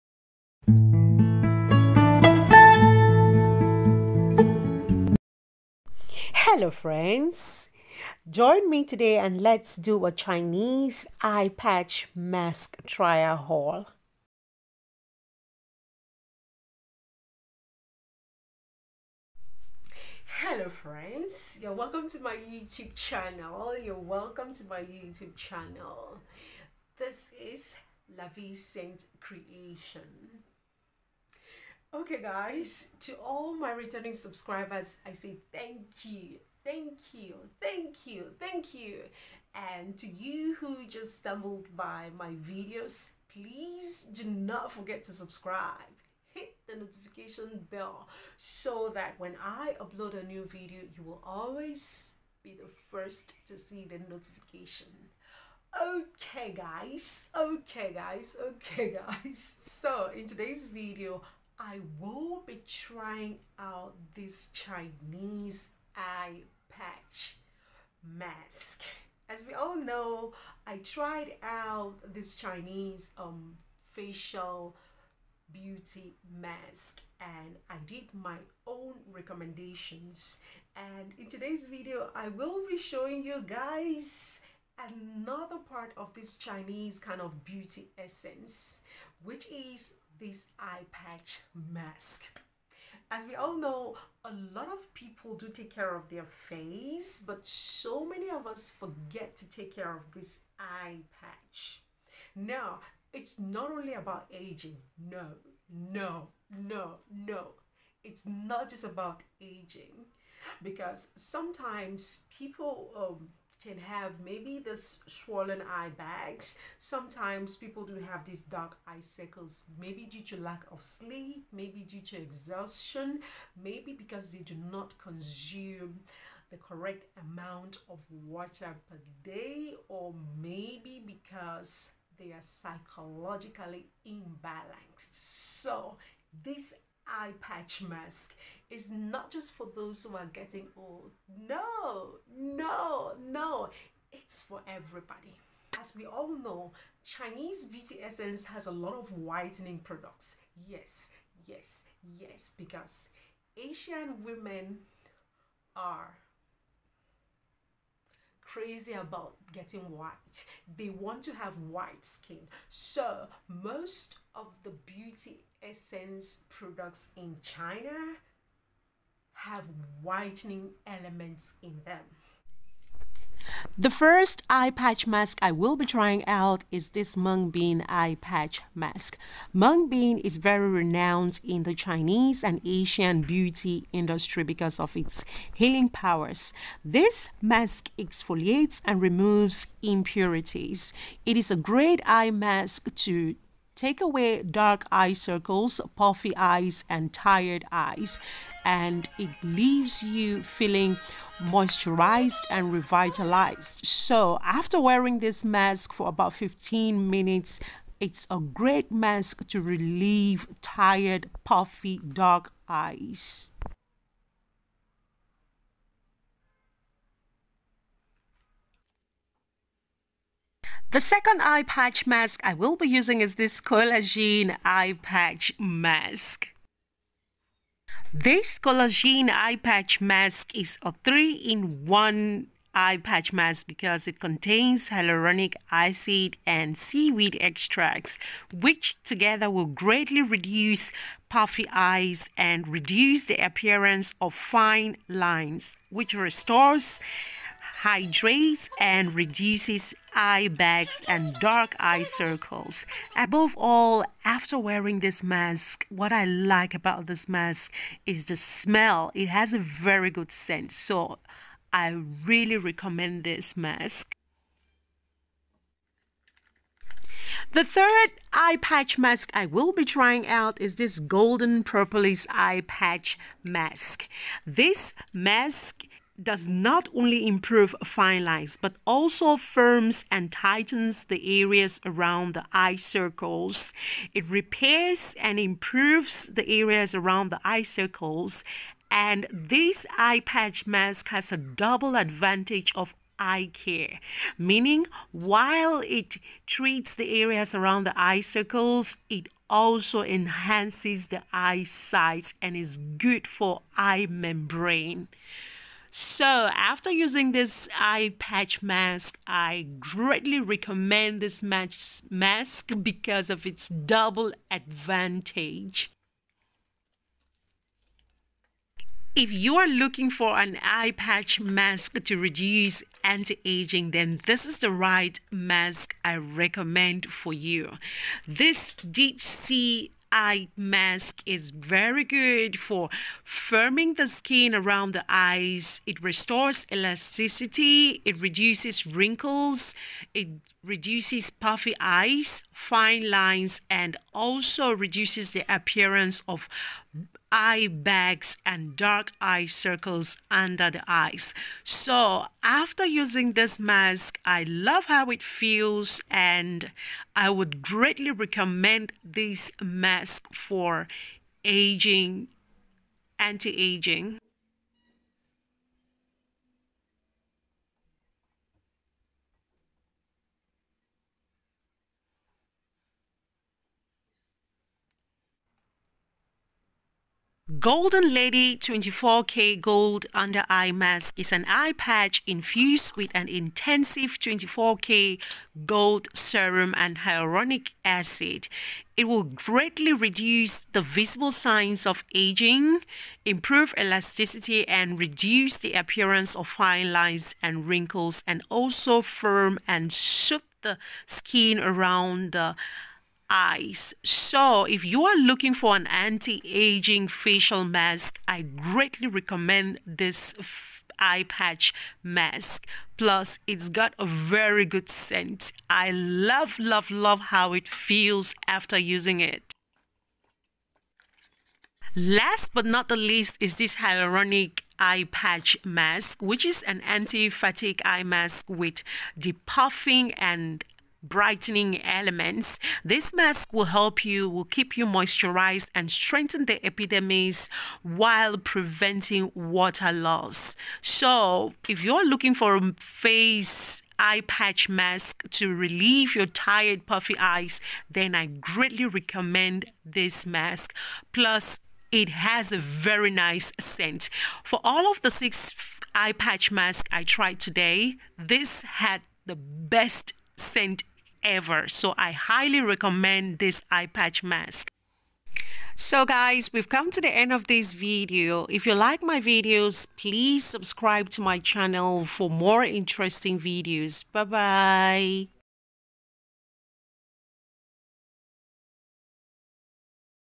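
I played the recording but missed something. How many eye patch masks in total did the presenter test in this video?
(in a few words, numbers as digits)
6.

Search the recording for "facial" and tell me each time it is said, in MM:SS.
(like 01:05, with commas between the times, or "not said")
01:13, 06:47.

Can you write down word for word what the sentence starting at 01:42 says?
Now, it's not only about aging.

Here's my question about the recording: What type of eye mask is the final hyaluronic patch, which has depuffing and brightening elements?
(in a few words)
Anti fatigue.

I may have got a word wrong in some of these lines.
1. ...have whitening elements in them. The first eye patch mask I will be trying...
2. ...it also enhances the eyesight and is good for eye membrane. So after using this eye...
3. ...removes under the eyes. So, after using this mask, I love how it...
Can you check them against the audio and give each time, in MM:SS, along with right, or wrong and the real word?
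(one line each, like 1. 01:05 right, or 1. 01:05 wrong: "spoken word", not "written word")
1. 02:49 right
2. 04:59 right
3. 05:49 wrong: "circles", not "removes".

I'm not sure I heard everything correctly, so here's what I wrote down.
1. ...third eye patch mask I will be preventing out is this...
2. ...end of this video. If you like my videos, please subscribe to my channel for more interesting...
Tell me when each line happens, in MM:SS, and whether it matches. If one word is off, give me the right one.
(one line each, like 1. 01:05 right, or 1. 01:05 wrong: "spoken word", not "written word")
1. 04:27 wrong: "trying", not "preventing"
2. 07:47 right.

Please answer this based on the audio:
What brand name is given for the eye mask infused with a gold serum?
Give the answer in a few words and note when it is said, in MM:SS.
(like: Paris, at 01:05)
Golden Lady, at 06:17.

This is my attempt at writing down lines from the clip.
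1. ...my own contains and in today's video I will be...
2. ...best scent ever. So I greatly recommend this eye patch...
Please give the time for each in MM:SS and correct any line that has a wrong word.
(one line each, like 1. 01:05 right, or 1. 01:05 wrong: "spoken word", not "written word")
1. 01:18 wrong: "recommendations", not "contains"
2. 07:39 wrong: "highly", not "greatly".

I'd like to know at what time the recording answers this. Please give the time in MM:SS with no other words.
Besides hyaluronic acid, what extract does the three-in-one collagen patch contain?
03:56.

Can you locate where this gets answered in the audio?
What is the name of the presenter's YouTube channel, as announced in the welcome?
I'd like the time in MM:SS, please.
00:28.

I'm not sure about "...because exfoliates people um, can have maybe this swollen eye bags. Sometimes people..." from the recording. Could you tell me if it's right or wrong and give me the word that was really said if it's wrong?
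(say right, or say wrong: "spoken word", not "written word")
wrong: "sometimes", not "exfoliates".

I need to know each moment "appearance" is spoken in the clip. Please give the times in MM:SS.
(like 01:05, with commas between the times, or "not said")
04:03, 05:45, 06:35.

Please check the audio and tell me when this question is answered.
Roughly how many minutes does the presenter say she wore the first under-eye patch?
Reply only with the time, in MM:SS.
03:26.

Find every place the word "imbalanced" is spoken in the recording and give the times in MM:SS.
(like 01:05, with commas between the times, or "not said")
02:14.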